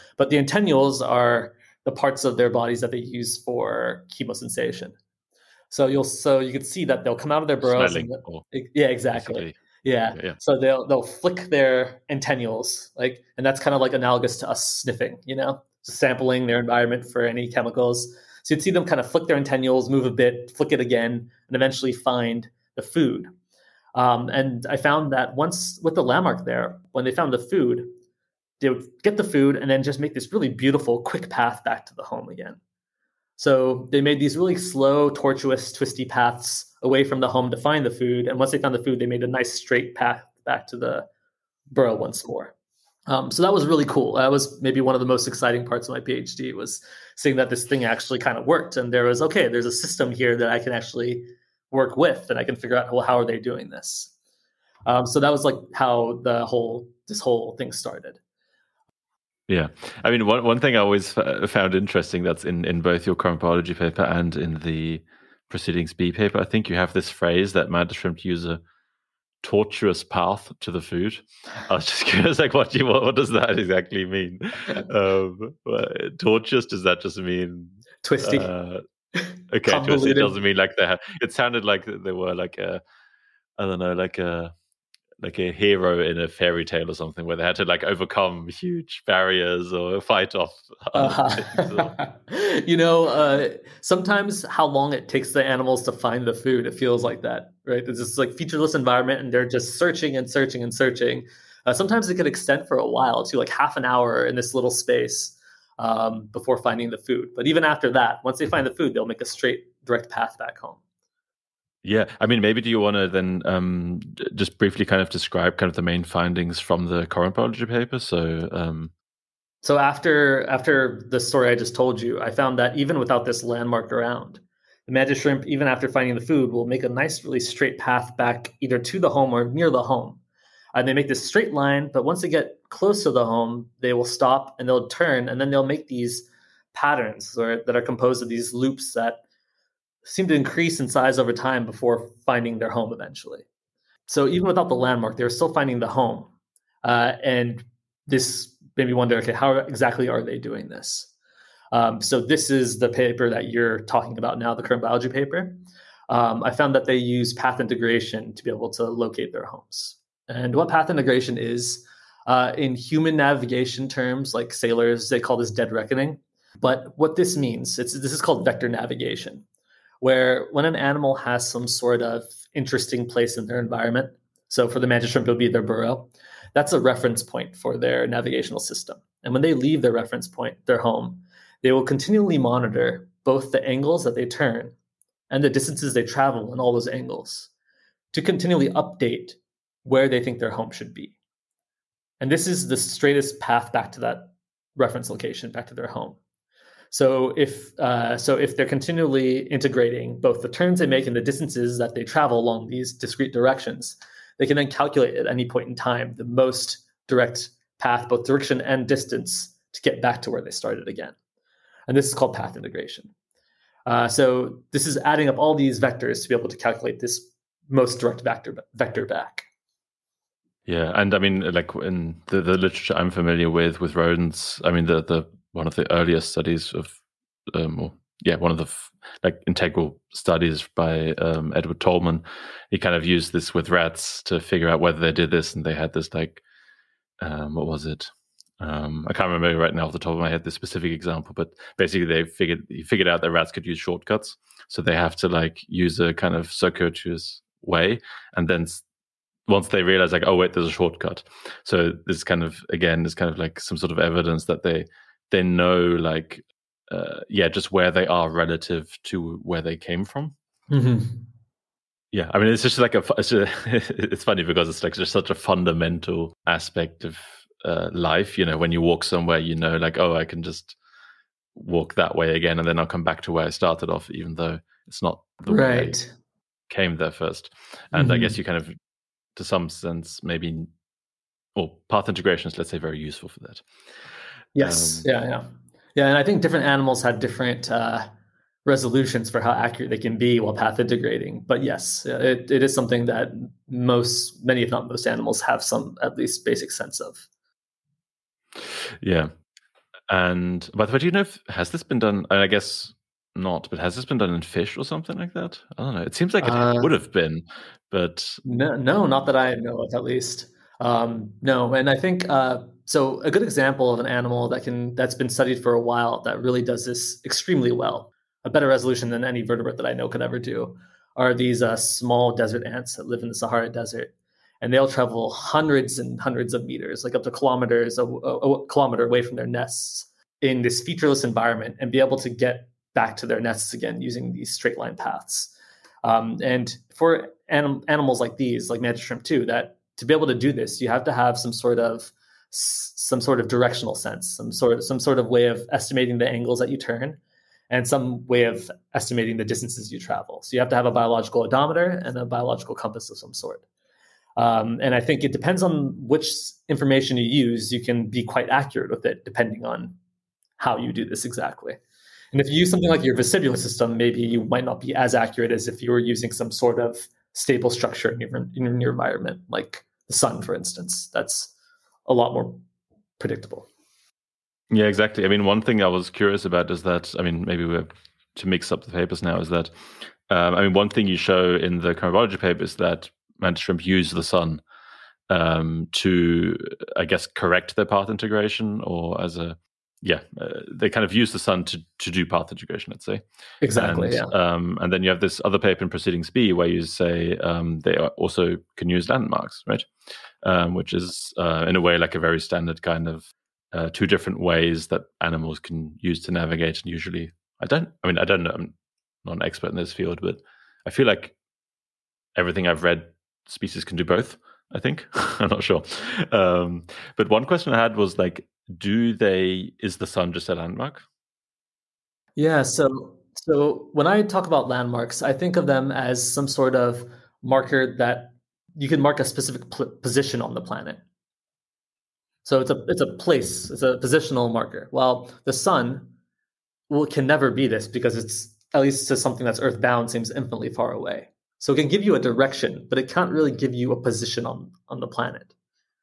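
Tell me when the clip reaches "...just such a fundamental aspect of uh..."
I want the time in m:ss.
4:24.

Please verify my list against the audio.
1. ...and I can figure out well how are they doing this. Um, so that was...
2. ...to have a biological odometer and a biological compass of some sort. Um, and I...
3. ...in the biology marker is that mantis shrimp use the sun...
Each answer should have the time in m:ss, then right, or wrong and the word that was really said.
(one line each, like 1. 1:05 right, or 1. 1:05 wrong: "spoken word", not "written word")
1. 0:52 right
2. 5:50 right
3. 6:21 wrong: "paper", not "marker".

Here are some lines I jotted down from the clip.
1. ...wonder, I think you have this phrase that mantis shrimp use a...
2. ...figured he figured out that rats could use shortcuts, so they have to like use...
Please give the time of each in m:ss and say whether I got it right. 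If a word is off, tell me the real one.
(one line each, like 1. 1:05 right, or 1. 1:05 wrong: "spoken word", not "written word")
1. 1:06 wrong: "paper", not "wonder"
2. 4:02 right.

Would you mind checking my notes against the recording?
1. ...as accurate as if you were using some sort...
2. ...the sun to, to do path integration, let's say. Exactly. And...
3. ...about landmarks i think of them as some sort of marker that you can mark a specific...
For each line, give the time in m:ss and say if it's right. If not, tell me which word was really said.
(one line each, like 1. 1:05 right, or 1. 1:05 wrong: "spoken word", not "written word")
1. 6:04 right
2. 6:31 right
3. 7:04 right.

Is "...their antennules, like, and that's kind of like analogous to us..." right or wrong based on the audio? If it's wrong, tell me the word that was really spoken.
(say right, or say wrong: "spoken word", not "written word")
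right.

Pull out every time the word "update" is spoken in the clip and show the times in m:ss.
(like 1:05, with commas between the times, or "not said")
3:08.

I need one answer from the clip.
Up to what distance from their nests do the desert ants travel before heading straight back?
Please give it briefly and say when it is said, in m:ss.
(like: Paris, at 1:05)
a kilometer, at 5:28.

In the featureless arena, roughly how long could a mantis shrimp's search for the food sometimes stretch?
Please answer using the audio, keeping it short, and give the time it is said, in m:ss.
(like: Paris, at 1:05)
half an hour, at 1:43.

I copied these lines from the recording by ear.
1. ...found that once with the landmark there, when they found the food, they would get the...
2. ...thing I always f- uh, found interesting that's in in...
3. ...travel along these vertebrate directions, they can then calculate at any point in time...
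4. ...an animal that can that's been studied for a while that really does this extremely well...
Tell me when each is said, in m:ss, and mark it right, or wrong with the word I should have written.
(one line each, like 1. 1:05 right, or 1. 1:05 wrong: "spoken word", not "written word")
1. 0:24 right
2. 1:00 right
3. 3:22 wrong: "discrete", not "vertebrate"
4. 5:13 right.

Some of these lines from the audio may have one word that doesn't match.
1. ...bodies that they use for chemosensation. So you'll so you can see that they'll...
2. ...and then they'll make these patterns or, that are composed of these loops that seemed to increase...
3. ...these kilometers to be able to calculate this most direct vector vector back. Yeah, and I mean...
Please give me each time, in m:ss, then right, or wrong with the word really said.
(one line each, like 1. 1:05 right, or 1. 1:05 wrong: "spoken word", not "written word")
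1. 0:02 right
2. 2:15 right
3. 3:35 wrong: "vectors", not "kilometers".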